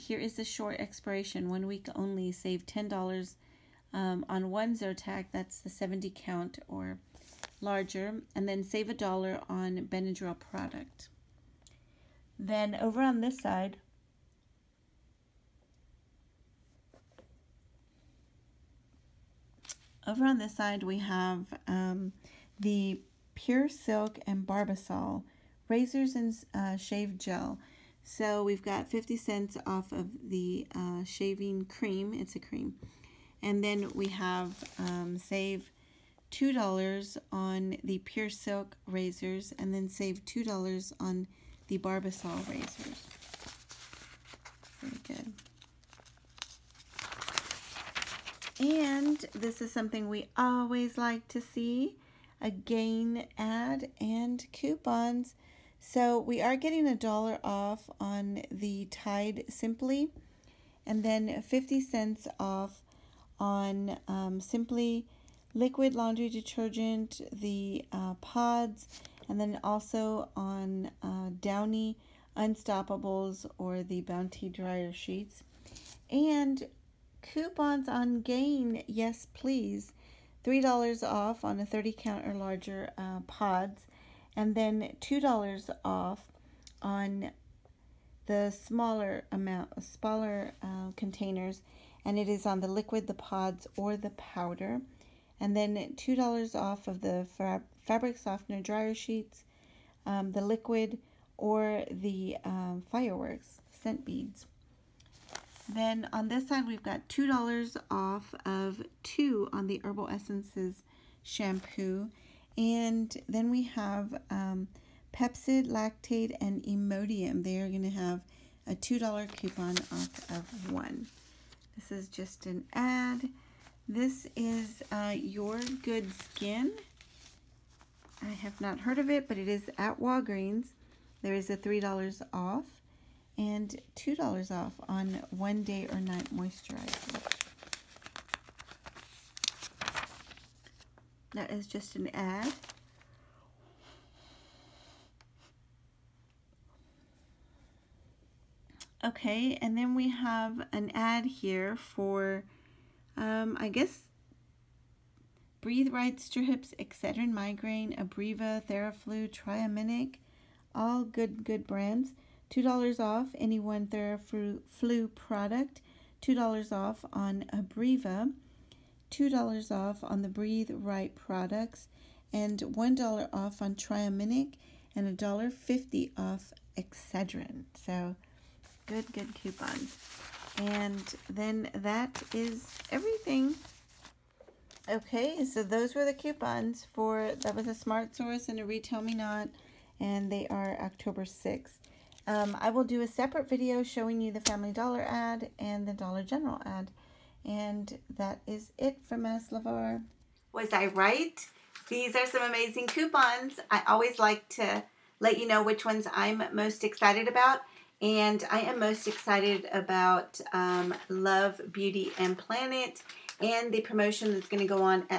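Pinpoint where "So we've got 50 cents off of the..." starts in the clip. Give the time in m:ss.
0:28.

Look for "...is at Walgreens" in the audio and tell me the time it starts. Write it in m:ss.
2:09.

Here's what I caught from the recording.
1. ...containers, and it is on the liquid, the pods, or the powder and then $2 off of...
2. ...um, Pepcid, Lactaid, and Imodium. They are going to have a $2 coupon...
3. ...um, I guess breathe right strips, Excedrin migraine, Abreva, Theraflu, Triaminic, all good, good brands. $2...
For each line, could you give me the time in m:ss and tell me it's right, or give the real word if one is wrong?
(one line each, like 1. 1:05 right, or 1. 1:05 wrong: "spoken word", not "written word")
1. 1:30 right
2. 1:54 right
3. 2:33 right.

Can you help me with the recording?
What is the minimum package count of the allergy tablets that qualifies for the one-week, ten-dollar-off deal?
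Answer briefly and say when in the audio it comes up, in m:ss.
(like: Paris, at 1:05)
70 count, at 0:05.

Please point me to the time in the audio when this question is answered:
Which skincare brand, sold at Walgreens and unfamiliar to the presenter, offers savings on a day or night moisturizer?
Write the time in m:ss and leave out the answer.
2:05.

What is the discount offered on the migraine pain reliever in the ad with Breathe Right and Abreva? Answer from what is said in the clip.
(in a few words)
$1.50.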